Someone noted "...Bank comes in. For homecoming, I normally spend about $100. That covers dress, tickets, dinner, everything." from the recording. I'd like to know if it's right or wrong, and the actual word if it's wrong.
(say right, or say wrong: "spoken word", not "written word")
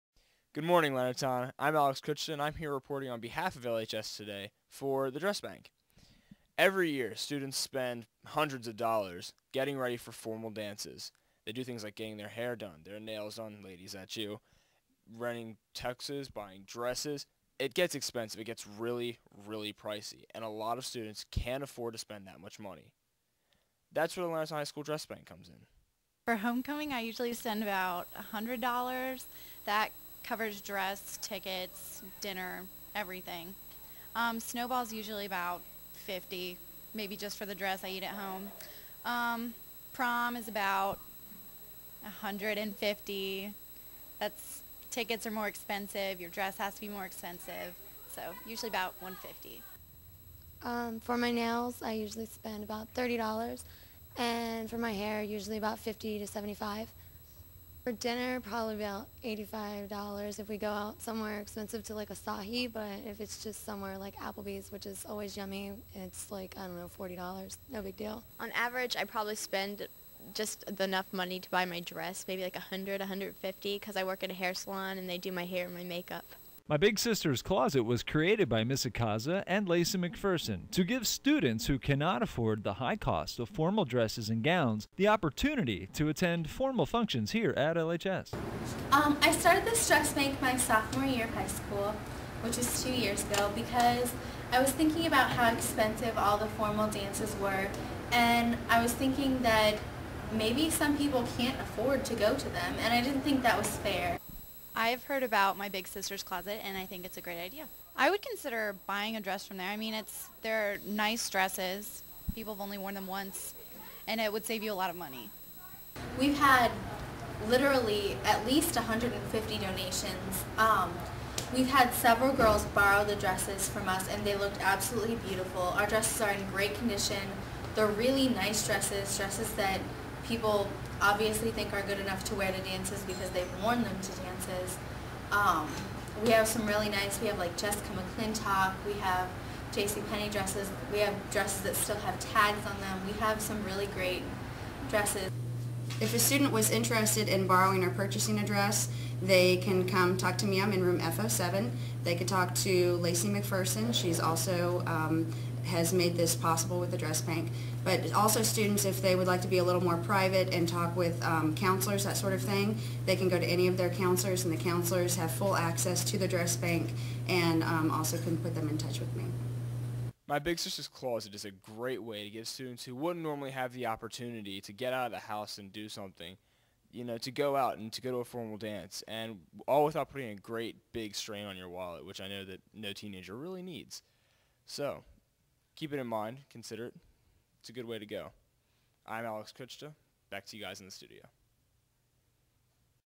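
wrong: "usually", not "normally".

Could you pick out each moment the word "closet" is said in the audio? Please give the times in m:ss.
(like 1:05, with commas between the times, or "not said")
1:17, 1:46, 2:50.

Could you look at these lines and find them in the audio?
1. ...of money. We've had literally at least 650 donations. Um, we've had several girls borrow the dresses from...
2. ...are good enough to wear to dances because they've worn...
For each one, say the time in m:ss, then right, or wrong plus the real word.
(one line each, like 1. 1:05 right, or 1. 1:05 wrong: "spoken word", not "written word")
1. 1:54 wrong: "150", not "650"
2. 2:11 right.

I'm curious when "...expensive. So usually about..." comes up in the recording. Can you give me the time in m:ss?
0:47.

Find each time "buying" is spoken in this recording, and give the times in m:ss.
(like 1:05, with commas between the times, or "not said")
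0:16, 1:48.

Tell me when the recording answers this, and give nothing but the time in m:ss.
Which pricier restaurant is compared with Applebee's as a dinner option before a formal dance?
1:02.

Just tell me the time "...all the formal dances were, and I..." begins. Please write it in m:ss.
1:36.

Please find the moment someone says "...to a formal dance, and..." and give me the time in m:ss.
2:58.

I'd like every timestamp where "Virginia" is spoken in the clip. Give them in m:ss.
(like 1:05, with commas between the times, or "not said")
not said.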